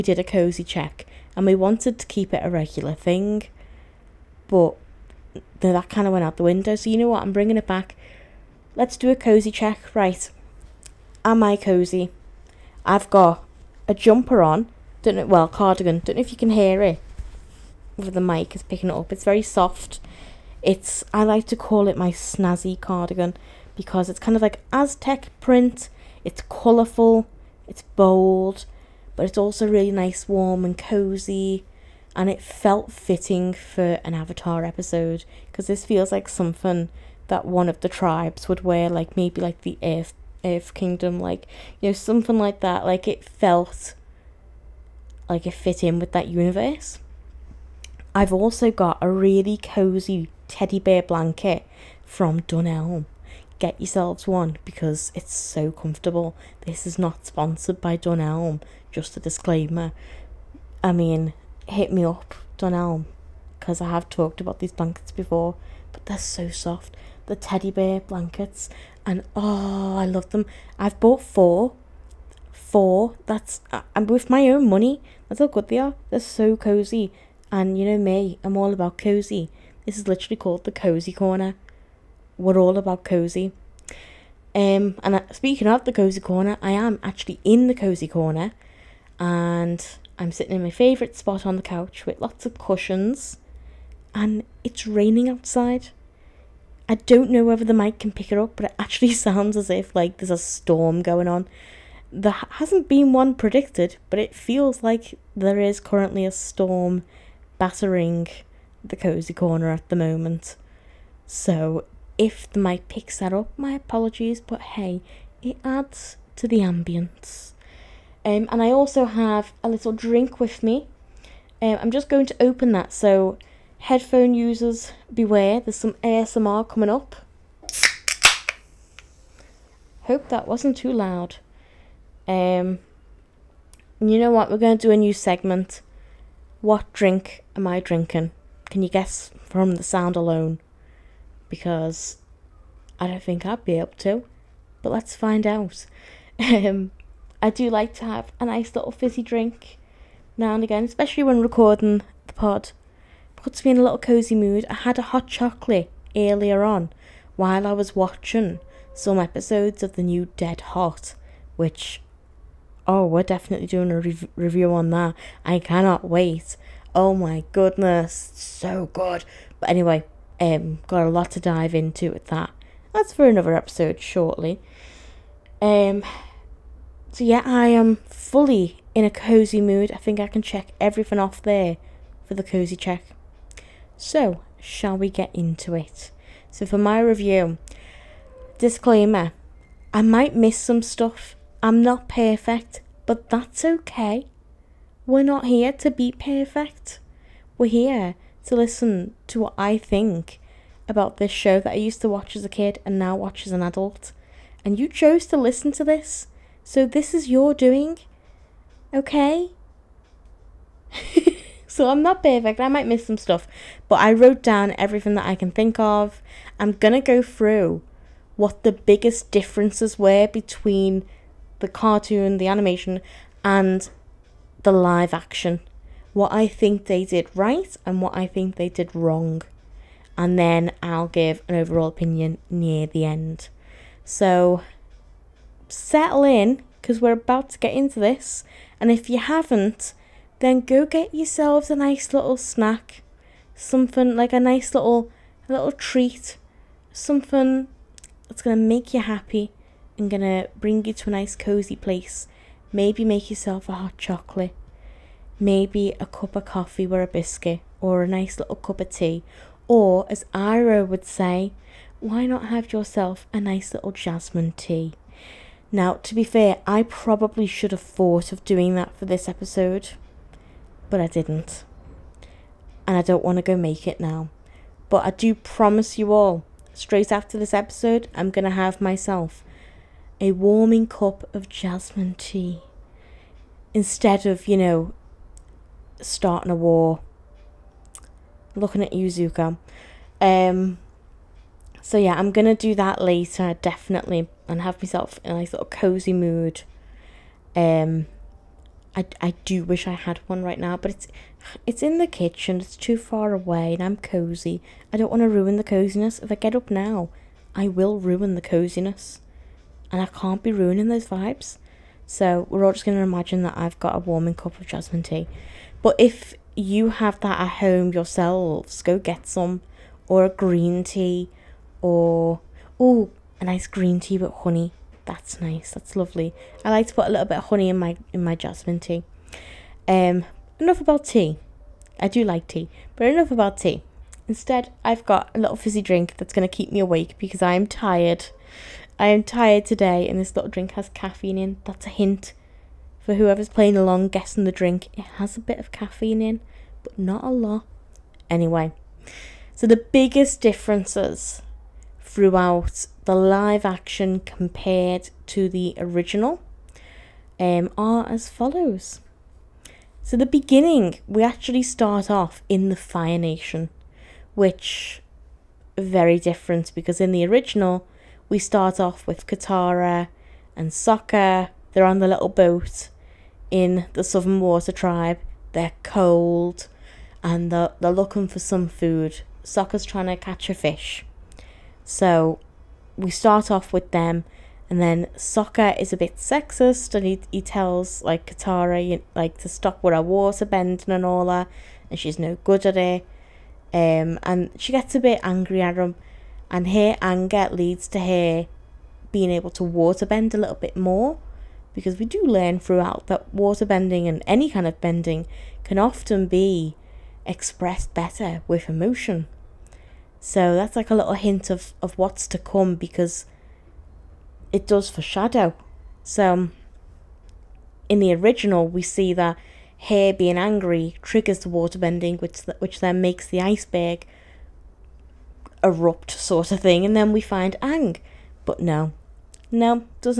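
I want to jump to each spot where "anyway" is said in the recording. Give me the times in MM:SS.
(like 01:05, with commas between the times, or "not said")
02:49, 05:48.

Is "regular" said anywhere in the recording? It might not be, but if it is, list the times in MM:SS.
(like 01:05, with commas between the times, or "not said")
00:02.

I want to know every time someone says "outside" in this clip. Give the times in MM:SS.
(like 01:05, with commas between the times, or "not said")
01:35.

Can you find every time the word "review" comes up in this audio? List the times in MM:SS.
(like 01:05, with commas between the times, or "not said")
02:44, 03:06.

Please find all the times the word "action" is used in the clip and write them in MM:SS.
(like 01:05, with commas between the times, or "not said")
03:45, 05:53.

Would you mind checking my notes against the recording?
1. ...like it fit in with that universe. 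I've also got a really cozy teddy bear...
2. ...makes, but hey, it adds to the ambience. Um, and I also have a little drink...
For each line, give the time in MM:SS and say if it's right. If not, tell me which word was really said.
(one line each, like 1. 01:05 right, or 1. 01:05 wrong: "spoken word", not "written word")
1. 00:45 right
2. 01:53 wrong: "apologies", not "makes".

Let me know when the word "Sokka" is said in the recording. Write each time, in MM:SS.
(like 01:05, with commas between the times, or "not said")
06:10, 06:19, 06:25.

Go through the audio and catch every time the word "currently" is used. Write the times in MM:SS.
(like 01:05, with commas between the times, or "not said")
01:45.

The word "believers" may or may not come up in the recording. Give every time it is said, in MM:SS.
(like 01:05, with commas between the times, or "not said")
not said.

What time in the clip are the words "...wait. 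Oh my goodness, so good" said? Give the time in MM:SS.
02:46.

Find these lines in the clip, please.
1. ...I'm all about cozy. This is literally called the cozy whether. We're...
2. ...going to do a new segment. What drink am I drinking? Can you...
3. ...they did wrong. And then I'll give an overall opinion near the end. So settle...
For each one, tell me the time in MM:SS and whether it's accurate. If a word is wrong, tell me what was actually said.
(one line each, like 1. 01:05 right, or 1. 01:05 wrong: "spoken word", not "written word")
1. 01:18 wrong: "corner", not "whether"
2. 02:14 right
3. 03:48 right.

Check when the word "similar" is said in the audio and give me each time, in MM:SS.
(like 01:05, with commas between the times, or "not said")
not said.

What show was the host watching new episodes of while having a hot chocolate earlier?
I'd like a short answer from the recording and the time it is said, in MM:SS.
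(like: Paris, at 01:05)
Dead Hot, at 02:40.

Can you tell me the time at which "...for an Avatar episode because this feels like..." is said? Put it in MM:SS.
00:33.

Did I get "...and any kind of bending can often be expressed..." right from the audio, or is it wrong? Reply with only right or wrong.
right.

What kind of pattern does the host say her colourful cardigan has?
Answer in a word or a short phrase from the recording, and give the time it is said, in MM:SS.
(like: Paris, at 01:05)
Aztec print, at 00:24.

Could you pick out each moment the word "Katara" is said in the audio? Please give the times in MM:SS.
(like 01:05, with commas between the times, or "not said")
06:09, 06:28.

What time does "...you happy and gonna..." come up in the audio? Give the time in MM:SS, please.
04:08.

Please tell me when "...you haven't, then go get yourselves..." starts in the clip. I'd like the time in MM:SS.
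03:59.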